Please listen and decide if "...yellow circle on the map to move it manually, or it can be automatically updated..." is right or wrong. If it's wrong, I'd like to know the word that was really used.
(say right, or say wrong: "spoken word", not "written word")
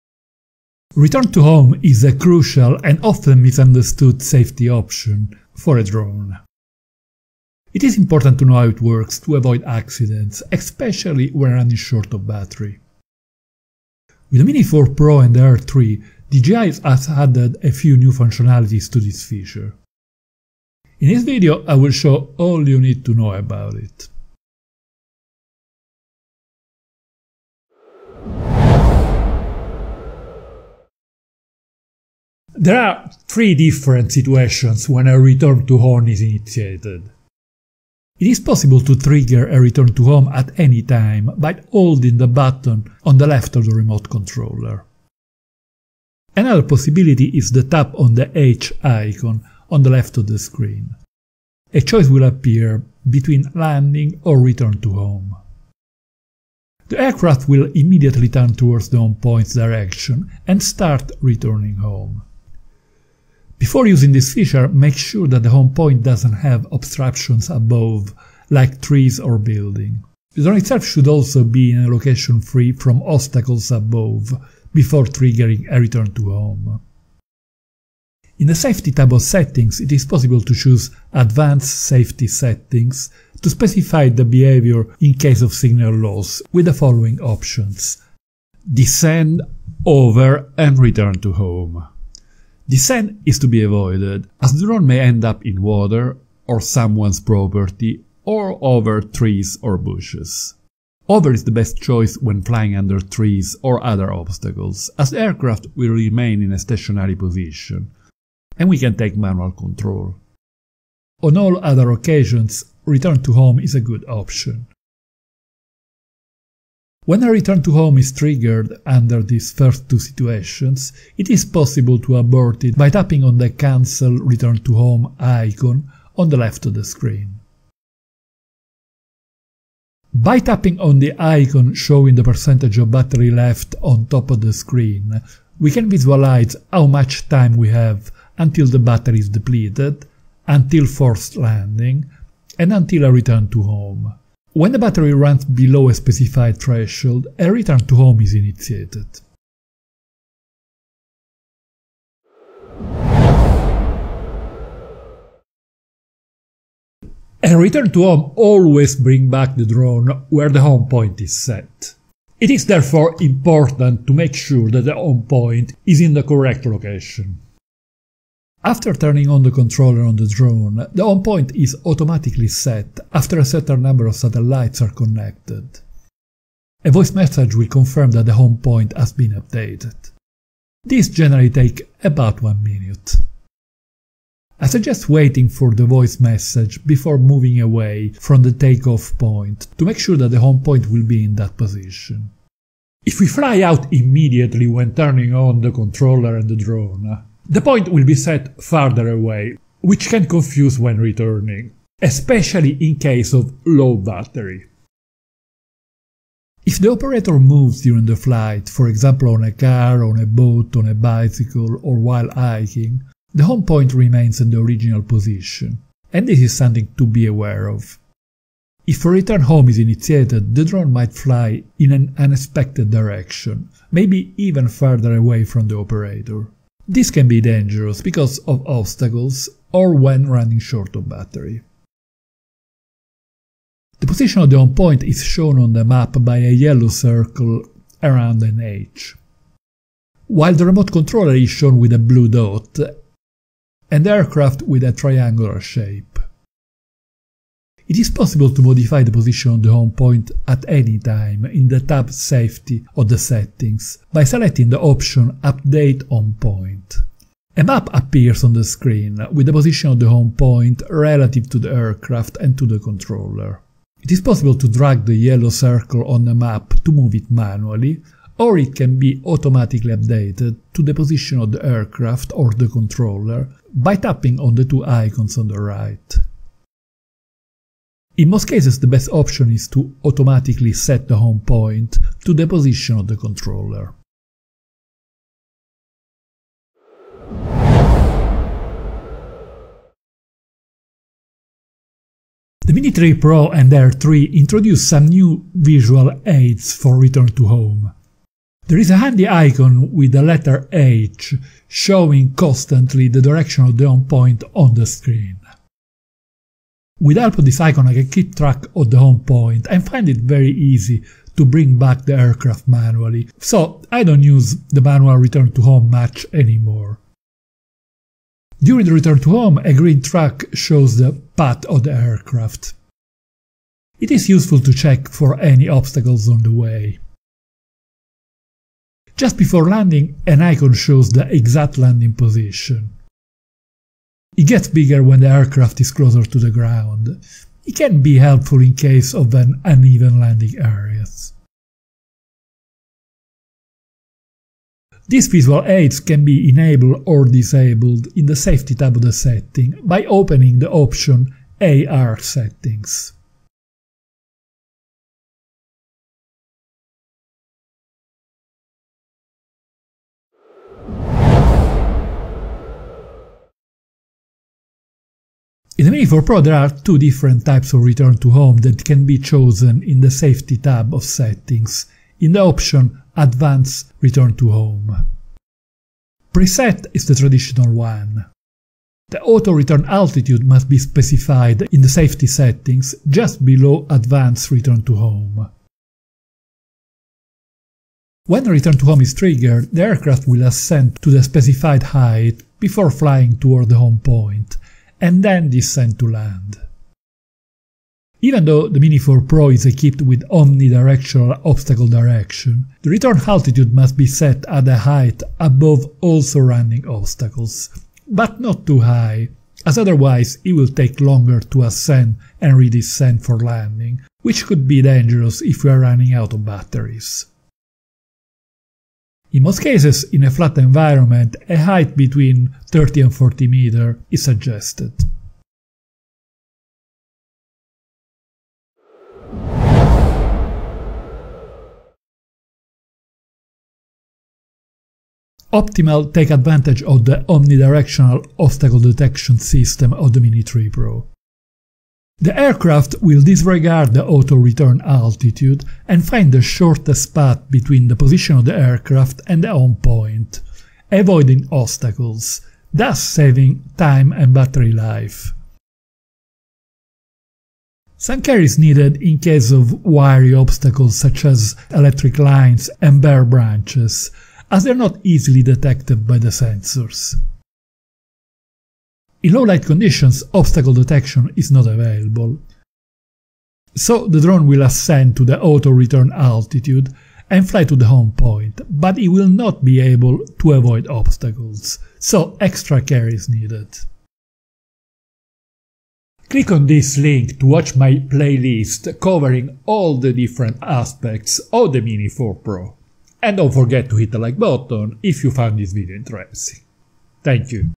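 right.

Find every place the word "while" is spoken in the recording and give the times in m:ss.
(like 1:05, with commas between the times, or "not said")
3:31, 4:00.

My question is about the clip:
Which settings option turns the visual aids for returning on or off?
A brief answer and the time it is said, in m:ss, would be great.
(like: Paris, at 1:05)
AR Settings, at 5:51.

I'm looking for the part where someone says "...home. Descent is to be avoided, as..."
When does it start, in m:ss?
1:31.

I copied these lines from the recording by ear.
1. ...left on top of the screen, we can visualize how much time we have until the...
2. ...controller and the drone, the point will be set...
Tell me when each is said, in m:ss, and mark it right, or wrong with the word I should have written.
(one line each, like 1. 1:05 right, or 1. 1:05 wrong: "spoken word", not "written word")
1. 2:13 right
2. 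3:15 right.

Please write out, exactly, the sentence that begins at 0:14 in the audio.
With the Mini 4 Pro and the Air 3, DJI has added a few new functionalities to this feature.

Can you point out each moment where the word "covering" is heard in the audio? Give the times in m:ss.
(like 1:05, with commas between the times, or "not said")
8:08.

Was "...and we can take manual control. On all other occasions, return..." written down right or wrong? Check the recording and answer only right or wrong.
right.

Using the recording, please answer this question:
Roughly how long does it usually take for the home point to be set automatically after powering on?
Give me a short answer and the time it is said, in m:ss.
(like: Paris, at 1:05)
About one minute, at 3:02.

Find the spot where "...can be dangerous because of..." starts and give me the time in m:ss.
3:47.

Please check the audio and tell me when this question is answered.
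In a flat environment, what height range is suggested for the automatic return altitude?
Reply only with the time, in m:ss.
7:01.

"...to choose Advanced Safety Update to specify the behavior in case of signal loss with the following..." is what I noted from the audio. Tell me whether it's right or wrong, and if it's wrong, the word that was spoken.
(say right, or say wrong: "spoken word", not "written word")
wrong: "Settings", not "Update".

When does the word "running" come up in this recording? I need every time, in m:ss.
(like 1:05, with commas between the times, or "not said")
0:11, 3:50, 6:55.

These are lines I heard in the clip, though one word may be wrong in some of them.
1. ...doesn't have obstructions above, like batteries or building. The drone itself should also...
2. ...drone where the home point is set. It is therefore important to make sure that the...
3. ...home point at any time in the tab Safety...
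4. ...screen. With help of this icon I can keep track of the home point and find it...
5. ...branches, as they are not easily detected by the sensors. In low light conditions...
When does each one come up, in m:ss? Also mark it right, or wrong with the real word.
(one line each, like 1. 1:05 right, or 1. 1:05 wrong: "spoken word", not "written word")
1. 1:06 wrong: "trees", not "batteries"
2. 2:39 right
3. 4:09 right
4. 5:04 right
5. 7:43 right.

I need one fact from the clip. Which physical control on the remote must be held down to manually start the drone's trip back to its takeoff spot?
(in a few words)
Button on the left.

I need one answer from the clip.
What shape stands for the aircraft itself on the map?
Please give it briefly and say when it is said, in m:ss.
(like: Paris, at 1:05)
Triangular shape, at 4:04.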